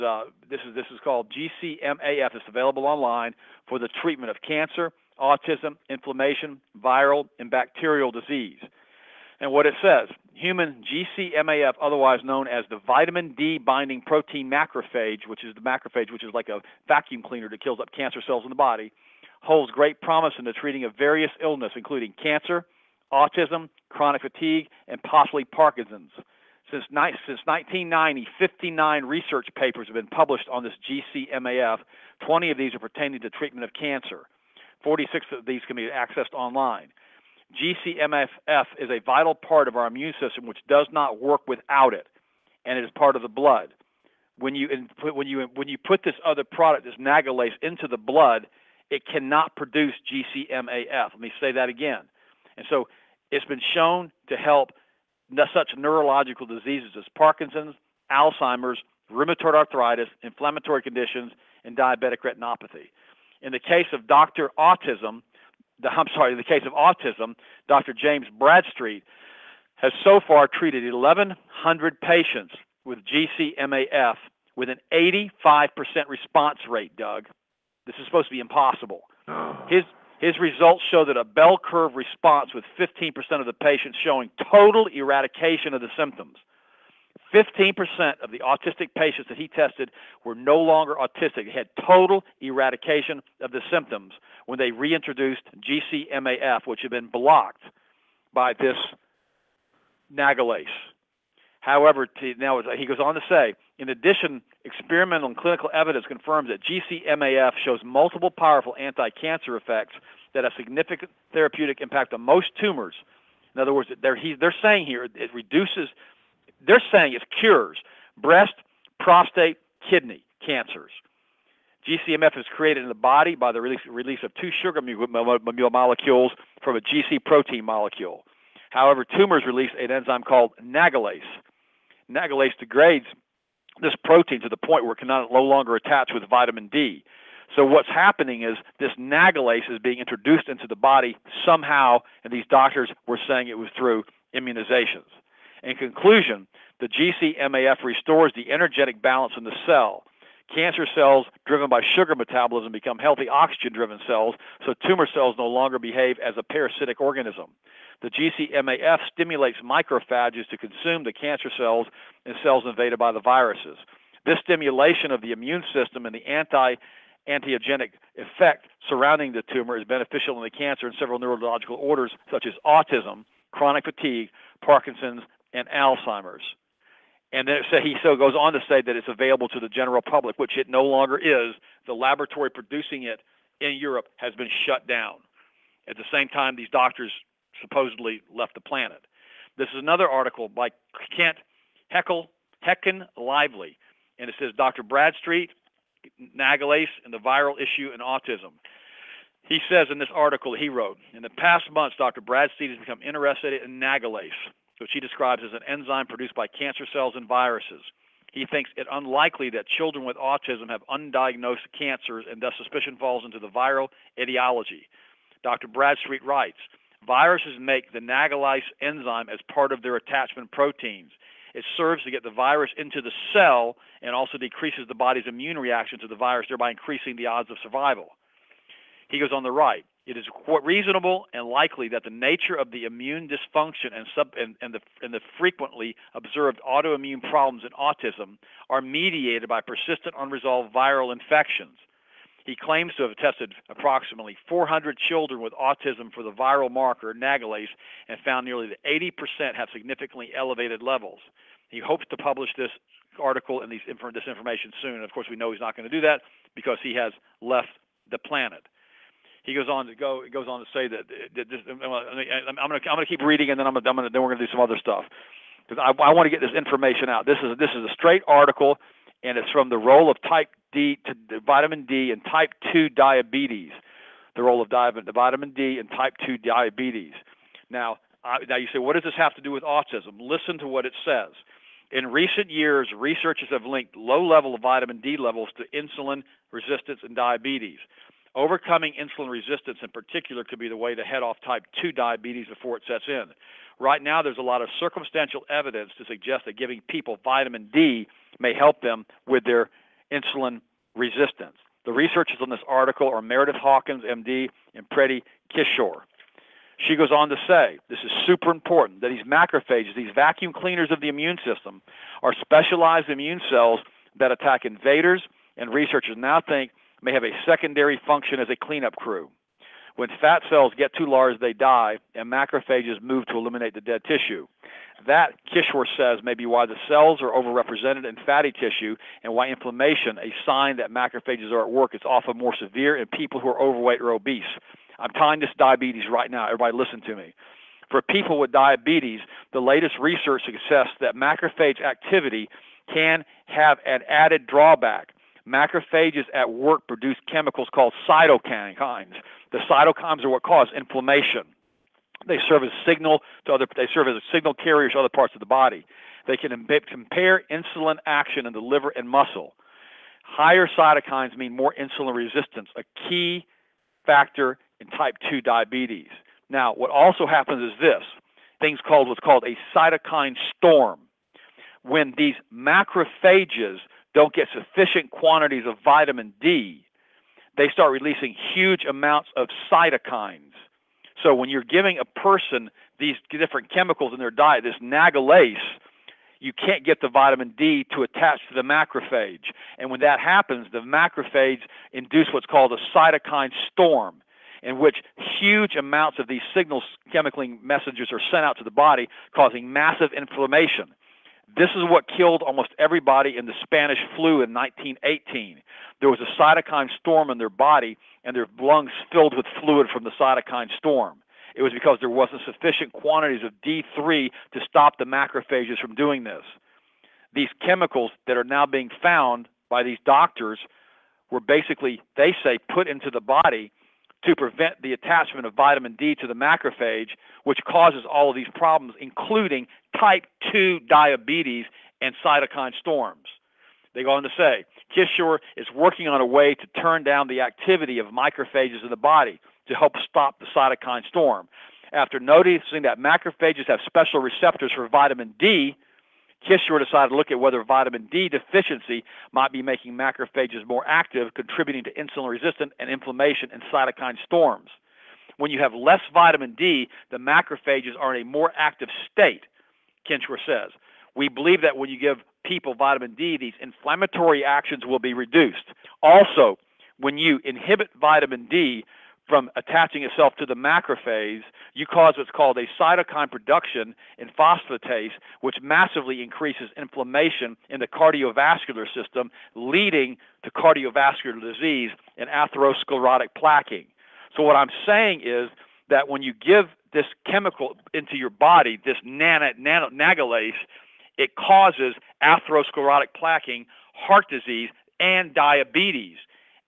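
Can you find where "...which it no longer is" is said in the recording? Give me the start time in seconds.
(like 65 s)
180 s.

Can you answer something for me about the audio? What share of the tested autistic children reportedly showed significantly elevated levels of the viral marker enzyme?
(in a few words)
nearly 80%.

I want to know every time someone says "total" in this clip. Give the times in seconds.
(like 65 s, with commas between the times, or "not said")
84 s, 91 s.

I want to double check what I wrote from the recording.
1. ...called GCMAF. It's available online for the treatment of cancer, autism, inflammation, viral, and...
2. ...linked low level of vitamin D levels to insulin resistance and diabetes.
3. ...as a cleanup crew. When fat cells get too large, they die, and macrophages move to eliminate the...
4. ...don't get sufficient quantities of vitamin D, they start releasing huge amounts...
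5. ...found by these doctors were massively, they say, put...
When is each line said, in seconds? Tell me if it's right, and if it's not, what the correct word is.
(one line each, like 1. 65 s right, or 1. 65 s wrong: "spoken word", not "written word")
1. 1 s right
2. 283 s right
3. 318 s right
4. 374 s right
5. 419 s wrong: "basically", not "massively".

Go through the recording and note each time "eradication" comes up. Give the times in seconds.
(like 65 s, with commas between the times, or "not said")
84 s, 92 s.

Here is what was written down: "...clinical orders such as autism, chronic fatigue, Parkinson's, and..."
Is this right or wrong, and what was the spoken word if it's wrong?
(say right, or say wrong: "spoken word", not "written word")
wrong: "neurological", not "clinical".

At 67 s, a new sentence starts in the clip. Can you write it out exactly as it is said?
James Bradstreet has so far treated 1,100 patients with GCMAF with an 85% response rate, Doug.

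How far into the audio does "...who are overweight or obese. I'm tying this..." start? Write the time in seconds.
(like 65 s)
333 s.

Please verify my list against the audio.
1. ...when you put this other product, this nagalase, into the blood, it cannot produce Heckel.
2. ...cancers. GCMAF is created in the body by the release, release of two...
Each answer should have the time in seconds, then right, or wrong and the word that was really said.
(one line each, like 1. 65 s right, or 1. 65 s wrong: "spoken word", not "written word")
1. 45 s wrong: "GCMAF", not "Heckel"
2. 120 s right.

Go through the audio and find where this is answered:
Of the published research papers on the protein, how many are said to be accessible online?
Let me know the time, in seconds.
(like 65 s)
34 s.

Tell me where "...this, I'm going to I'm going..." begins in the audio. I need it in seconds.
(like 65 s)
261 s.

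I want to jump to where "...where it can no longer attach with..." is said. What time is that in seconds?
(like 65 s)
134 s.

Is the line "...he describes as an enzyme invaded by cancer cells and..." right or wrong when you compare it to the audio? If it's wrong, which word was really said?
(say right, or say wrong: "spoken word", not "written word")
wrong: "produced", not "invaded".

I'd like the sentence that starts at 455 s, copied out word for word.
When you have less vitamin D, the macrophages are in a more active state, Kishore says.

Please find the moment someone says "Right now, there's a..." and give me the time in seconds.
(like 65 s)
293 s.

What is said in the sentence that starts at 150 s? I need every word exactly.
Cancer cells driven by sugar metabolism become healthy oxygen driven cells, so tumor cells no longer behave as a parasitic organism.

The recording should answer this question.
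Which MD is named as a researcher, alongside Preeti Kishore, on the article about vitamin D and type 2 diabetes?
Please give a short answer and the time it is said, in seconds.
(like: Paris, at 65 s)
Meredith Hawkins, at 303 s.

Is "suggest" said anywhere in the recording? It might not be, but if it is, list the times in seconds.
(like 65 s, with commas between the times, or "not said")
296 s, 340 s.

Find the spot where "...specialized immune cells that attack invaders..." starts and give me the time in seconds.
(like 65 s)
312 s.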